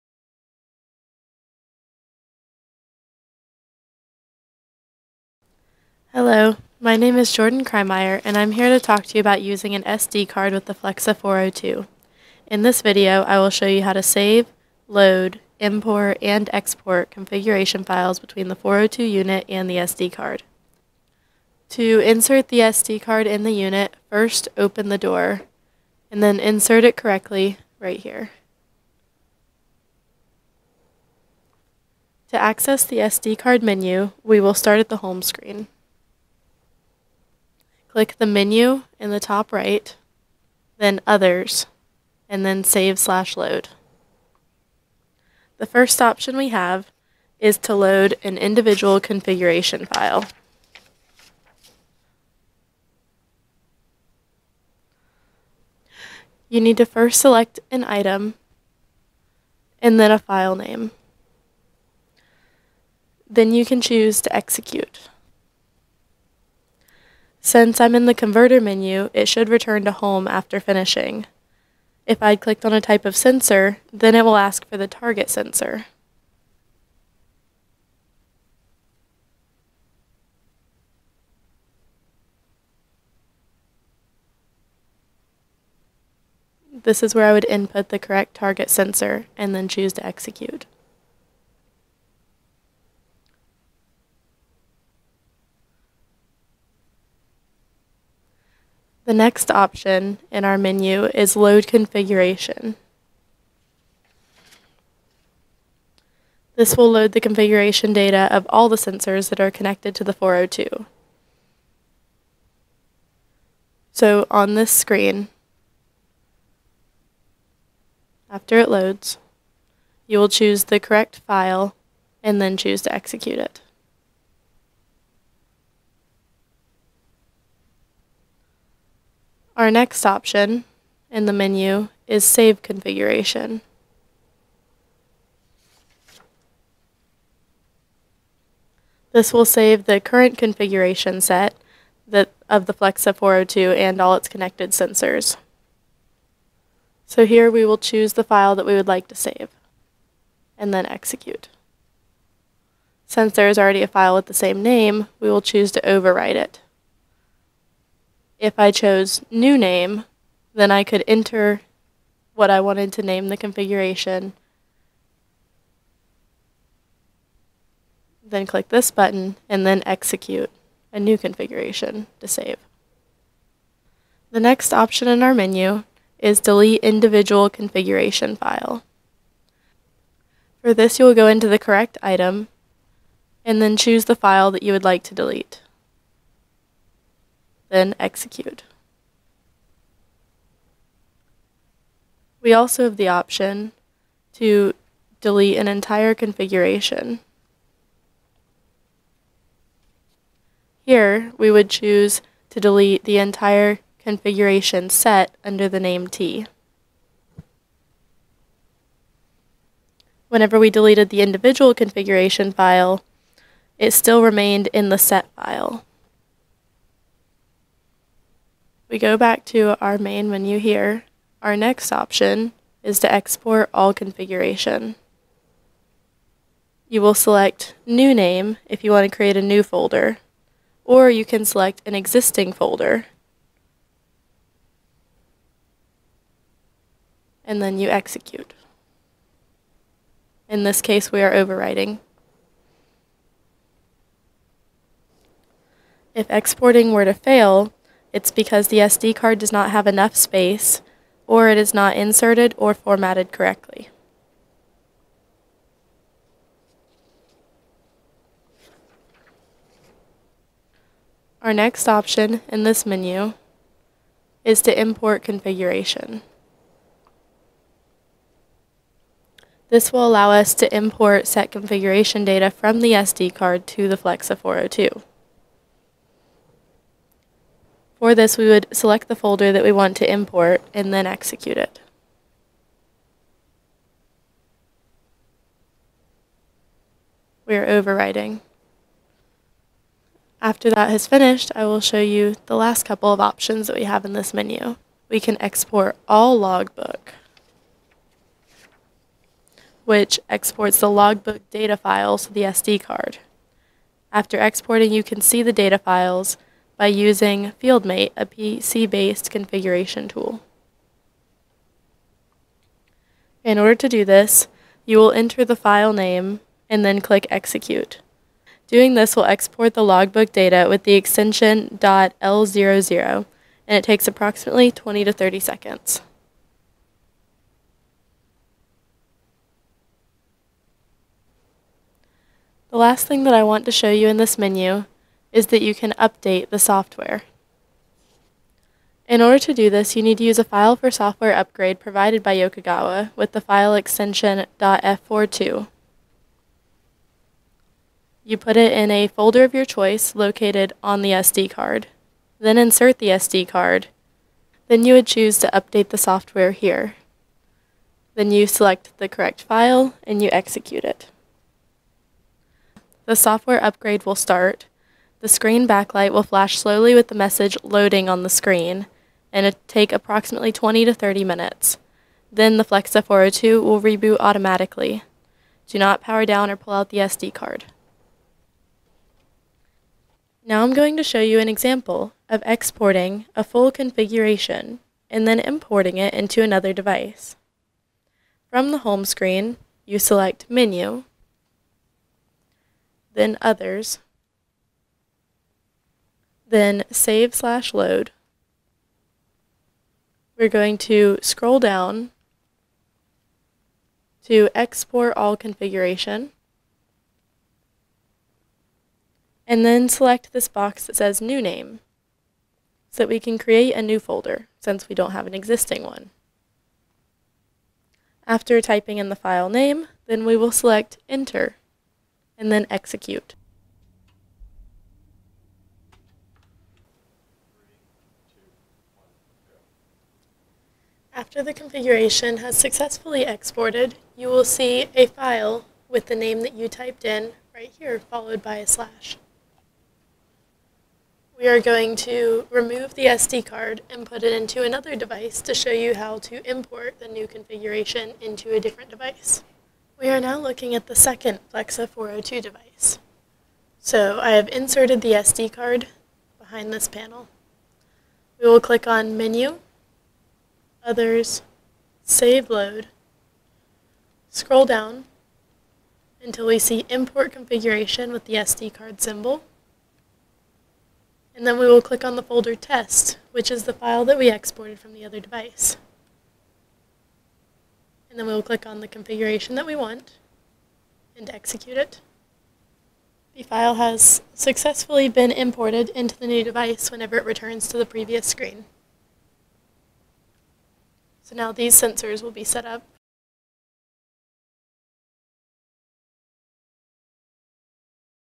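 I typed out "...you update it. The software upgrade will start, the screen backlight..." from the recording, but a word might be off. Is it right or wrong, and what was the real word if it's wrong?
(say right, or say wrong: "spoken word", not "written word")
wrong: "execute", not "update".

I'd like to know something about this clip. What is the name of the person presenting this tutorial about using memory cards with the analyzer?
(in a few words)
Jordan Krymeyer.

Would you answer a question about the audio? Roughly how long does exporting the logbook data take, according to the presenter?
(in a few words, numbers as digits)
20 to 30 seconds.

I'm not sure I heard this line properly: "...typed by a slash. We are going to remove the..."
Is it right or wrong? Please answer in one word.
wrong.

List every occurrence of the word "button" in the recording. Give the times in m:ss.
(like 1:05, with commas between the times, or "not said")
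2:48.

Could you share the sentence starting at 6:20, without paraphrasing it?
Now I'm going to show you an example of exporting a full configuration and then importing it into another device.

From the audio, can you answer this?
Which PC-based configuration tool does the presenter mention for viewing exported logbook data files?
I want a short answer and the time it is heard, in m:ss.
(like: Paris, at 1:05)
FieldMate, at 5:07.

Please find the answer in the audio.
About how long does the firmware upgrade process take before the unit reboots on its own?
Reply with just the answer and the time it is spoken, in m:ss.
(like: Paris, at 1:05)
20 to 30 minutes, at 6:10.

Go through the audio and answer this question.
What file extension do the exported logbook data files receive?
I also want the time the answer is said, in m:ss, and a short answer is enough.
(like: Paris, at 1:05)
.l00, at 5:21.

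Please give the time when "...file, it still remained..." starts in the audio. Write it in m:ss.
3:32.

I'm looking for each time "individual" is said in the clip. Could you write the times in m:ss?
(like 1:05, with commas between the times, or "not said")
0:48, 2:56, 3:31.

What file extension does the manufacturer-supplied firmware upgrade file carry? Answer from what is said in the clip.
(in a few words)
.f42.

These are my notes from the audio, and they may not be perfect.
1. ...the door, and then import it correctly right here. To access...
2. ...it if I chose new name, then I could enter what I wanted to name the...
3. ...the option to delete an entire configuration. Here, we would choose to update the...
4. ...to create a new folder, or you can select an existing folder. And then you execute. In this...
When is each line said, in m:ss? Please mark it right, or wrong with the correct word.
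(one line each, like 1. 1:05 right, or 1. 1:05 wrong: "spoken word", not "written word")
1. 0:24 wrong: "insert", not "import"
2. 2:36 right
3. 3:12 wrong: "delete", not "update"
4. 3:49 right.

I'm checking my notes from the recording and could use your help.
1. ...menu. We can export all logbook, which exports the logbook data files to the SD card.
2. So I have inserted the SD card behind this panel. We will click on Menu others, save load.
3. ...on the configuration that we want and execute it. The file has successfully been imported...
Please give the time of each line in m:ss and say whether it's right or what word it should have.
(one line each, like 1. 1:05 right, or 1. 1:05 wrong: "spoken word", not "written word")
1. 4:54 right
2. 7:33 right
3. 7:58 right.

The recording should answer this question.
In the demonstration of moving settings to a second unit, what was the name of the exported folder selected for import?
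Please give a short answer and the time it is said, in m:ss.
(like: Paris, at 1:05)
test, at 7:52.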